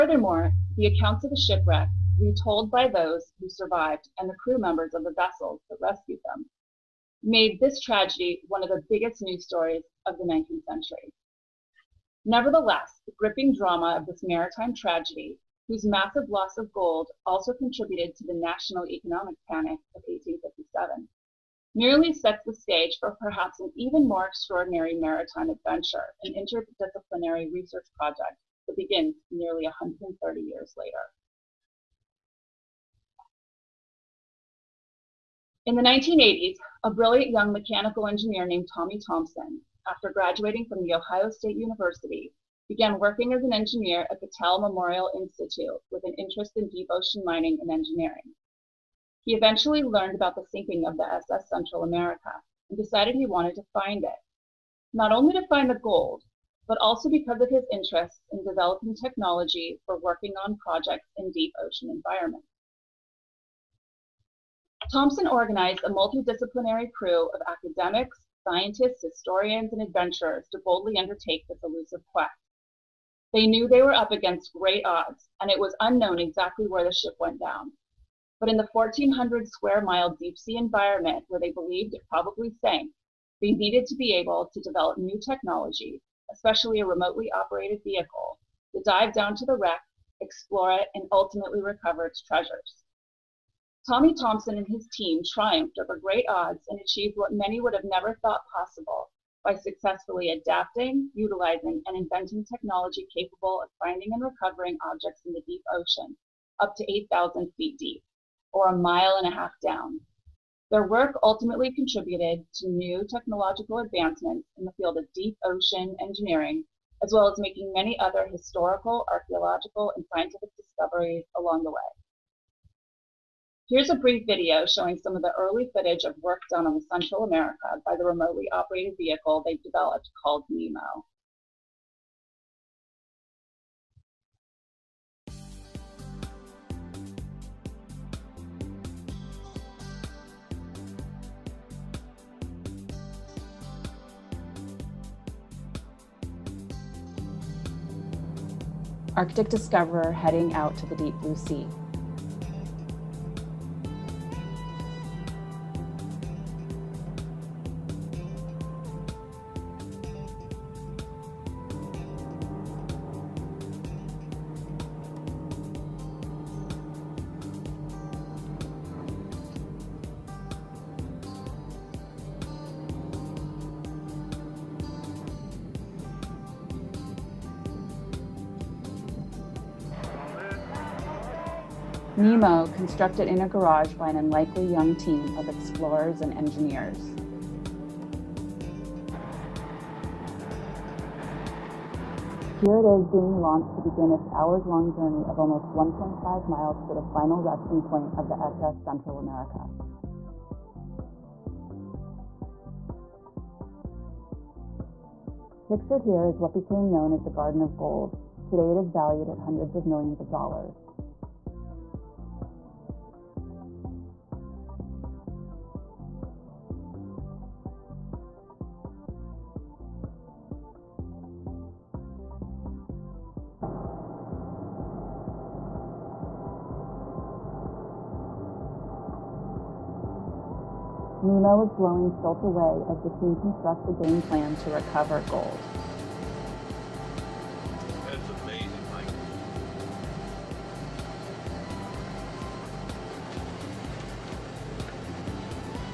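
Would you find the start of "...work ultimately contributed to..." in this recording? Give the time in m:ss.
1:50.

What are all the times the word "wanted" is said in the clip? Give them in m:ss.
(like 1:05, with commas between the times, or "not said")
0:53.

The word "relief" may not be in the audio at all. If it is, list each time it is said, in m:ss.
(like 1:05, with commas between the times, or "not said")
not said.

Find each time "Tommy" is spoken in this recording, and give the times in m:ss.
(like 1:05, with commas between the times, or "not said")
0:38, 1:33.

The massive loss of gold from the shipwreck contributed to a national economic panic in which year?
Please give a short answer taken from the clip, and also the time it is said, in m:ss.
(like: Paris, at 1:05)
1855, at 0:20.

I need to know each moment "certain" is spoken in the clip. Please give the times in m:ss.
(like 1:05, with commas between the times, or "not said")
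not said.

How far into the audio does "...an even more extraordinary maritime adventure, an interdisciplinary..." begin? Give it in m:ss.
0:23.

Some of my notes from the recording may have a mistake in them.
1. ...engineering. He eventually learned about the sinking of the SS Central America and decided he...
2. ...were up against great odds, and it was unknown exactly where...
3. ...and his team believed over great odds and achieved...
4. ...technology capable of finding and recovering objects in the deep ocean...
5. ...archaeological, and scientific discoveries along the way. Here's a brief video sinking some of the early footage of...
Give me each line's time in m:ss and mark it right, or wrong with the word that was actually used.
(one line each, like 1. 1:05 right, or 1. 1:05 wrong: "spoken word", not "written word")
1. 0:47 right
2. 1:13 right
3. 1:34 wrong: "triumphed", not "believed"
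4. 1:42 right
5. 1:59 wrong: "showing", not "sinking".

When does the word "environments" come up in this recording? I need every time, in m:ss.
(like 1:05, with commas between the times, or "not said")
1:01, 1:20.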